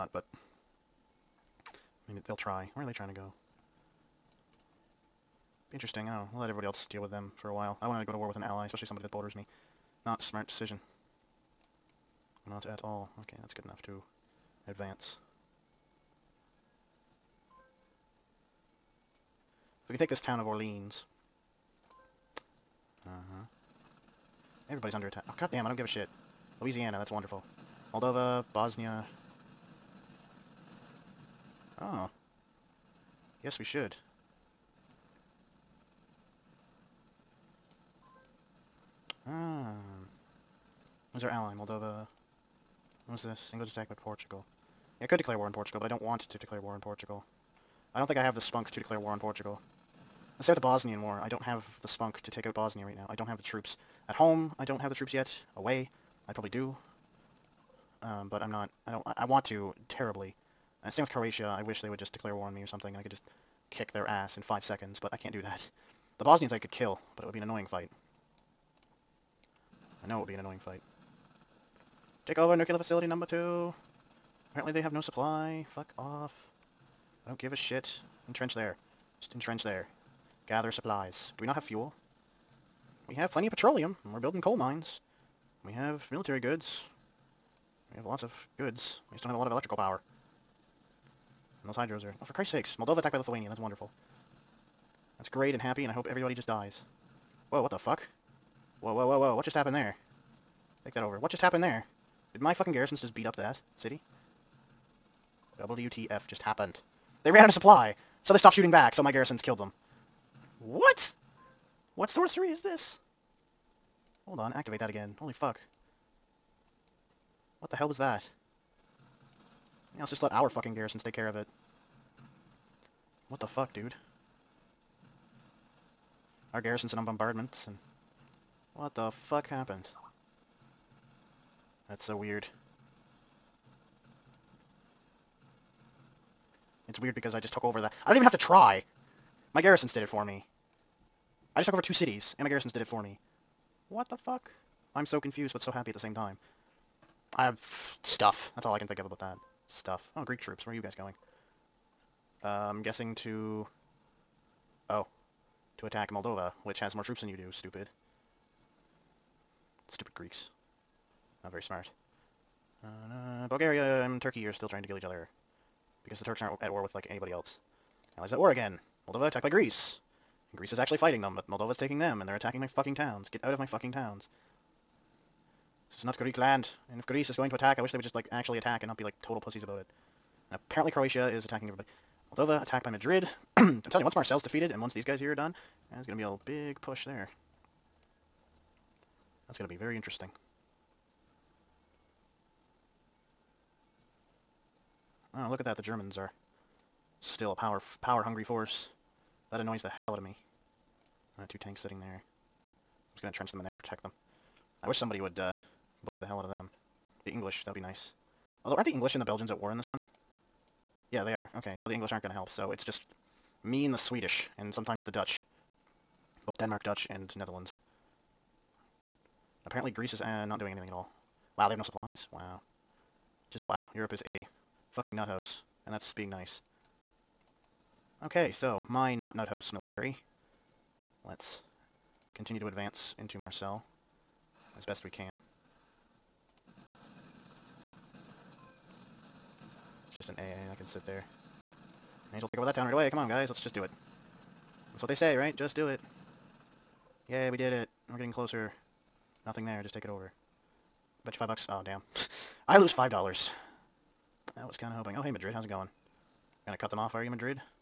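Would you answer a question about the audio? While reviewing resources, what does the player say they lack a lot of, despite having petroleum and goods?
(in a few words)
Electrical power.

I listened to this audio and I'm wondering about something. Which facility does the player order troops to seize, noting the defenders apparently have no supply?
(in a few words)
Nuclear facility number two.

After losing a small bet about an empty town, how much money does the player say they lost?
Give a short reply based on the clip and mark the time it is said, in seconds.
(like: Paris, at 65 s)
5 dollars, at 252 s.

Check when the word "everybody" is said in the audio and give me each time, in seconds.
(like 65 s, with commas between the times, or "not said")
6 s, 24 s, 96 s, 181 s.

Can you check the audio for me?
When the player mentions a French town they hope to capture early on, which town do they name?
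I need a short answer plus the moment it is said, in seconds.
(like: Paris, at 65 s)
Orleans, at 20 s.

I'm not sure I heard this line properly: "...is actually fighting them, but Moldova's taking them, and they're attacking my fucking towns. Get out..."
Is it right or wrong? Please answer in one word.
right.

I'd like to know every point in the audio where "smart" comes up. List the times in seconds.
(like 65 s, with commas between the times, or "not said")
10 s, 161 s.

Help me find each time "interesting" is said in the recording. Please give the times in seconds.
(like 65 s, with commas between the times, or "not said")
5 s, 189 s.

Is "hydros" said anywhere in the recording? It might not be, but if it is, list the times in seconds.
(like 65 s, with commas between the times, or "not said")
91 s.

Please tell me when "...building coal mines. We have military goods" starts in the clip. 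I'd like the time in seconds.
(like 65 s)
84 s.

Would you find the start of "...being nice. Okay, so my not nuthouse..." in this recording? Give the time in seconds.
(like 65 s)
226 s.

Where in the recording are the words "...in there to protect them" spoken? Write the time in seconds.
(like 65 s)
203 s.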